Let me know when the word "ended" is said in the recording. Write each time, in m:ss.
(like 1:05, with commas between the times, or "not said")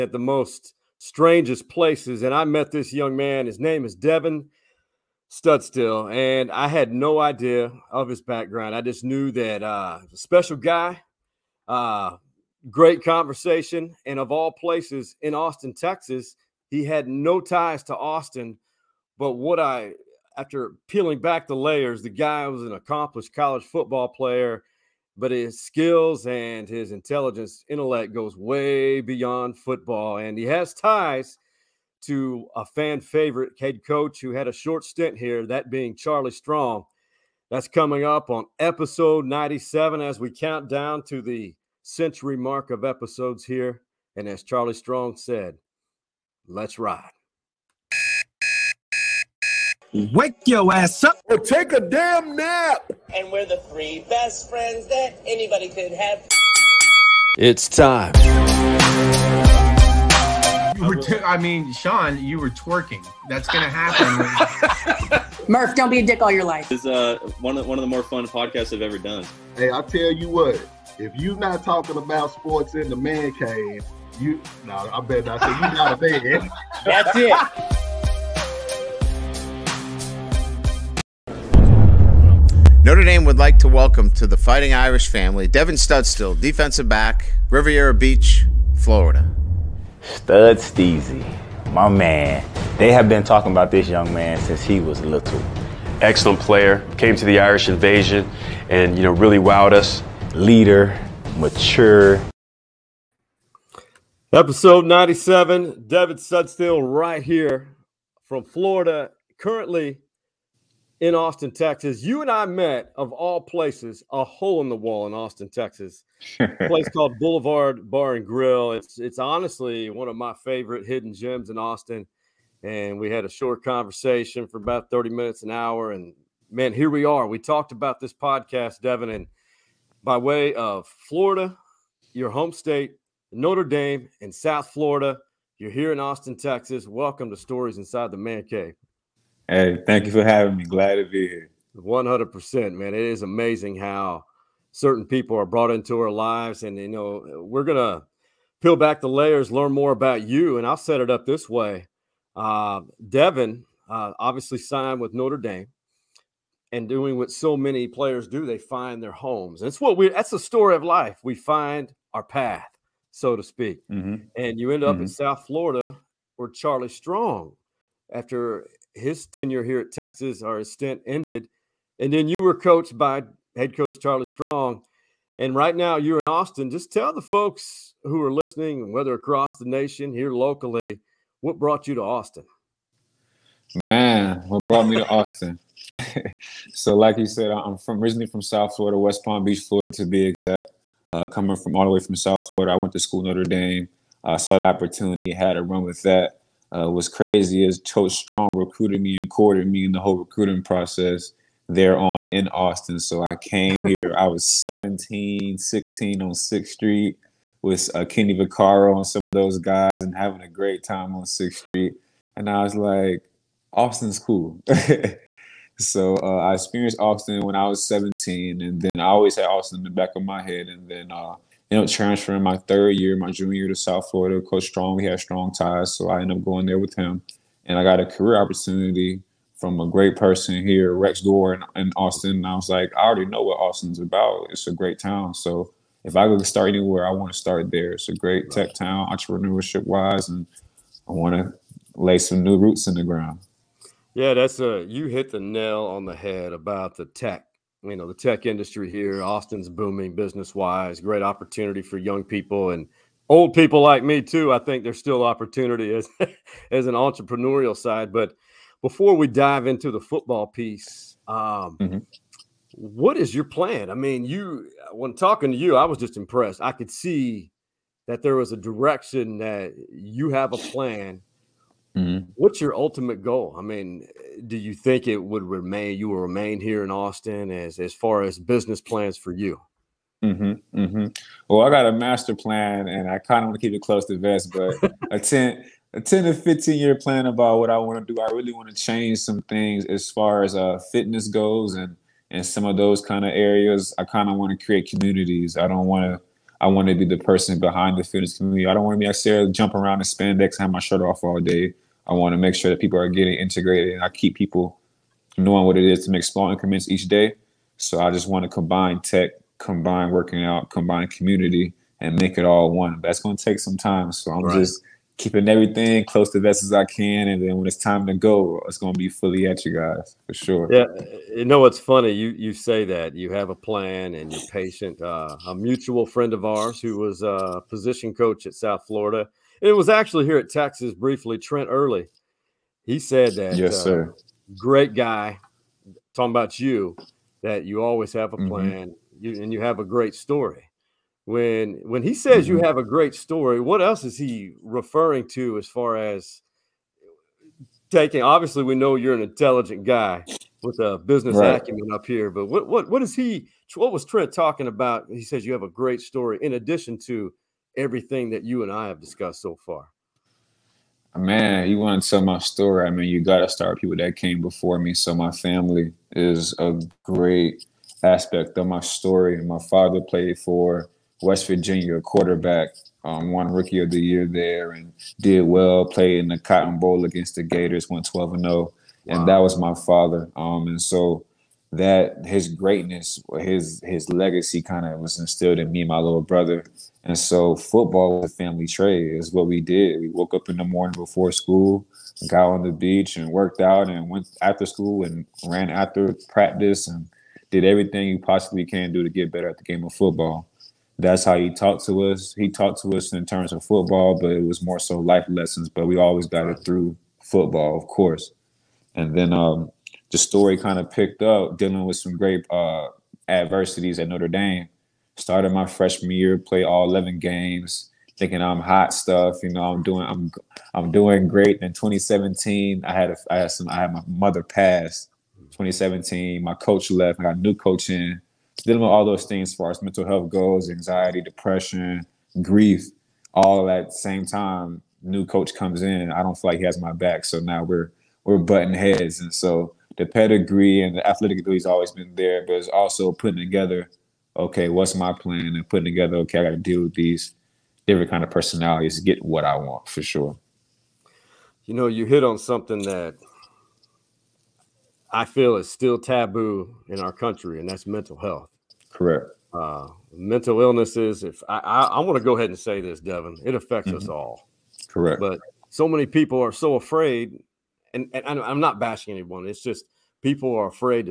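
2:51, 3:41, 3:46.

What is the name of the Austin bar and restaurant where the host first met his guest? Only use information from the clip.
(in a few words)
Boulevard Bar and Grill.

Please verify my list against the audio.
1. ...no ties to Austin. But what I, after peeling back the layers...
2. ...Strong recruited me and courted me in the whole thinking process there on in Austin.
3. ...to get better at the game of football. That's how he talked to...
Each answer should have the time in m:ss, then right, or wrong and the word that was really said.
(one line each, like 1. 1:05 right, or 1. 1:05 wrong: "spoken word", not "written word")
1. 0:17 right
2. 3:18 wrong: "recruiting", not "thinking"
3. 6:39 right.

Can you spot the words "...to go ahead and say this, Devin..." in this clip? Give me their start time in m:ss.
7:42.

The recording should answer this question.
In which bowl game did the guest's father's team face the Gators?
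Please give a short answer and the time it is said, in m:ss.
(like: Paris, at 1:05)
Cotton Bowl, at 6:16.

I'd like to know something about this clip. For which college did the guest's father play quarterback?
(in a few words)
West Virginia.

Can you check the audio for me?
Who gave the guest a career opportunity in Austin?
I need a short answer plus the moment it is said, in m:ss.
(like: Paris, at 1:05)
Rex Gore, at 3:50.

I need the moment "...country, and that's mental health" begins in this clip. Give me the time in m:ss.
7:37.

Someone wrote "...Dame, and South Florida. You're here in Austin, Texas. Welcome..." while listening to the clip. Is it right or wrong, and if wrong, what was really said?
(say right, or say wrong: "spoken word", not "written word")
right.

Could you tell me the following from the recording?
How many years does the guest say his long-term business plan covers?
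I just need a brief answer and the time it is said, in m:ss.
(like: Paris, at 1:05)
10 to 15 years, at 4:45.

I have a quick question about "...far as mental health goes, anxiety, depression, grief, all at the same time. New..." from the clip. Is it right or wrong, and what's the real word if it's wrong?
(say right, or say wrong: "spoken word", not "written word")
right.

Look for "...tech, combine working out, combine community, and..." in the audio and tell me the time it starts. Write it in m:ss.
5:09.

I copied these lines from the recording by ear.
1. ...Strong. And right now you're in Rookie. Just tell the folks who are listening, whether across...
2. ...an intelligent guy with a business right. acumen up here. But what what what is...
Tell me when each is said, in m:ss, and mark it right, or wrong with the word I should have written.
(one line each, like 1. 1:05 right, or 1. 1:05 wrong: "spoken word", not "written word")
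1. 2:54 wrong: "Austin", not "Rookie"
2. 5:49 right.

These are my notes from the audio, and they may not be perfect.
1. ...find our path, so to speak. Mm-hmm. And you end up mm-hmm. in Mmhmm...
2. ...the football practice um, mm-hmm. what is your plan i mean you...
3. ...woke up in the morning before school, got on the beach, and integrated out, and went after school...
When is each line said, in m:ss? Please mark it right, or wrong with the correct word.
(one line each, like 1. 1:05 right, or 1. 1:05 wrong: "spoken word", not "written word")
1. 2:41 wrong: "South", not "Mmhmm"
2. 4:19 wrong: "piece", not "practice"
3. 6:30 wrong: "worked", not "integrated".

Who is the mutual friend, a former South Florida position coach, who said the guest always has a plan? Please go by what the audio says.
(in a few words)
Trent Early.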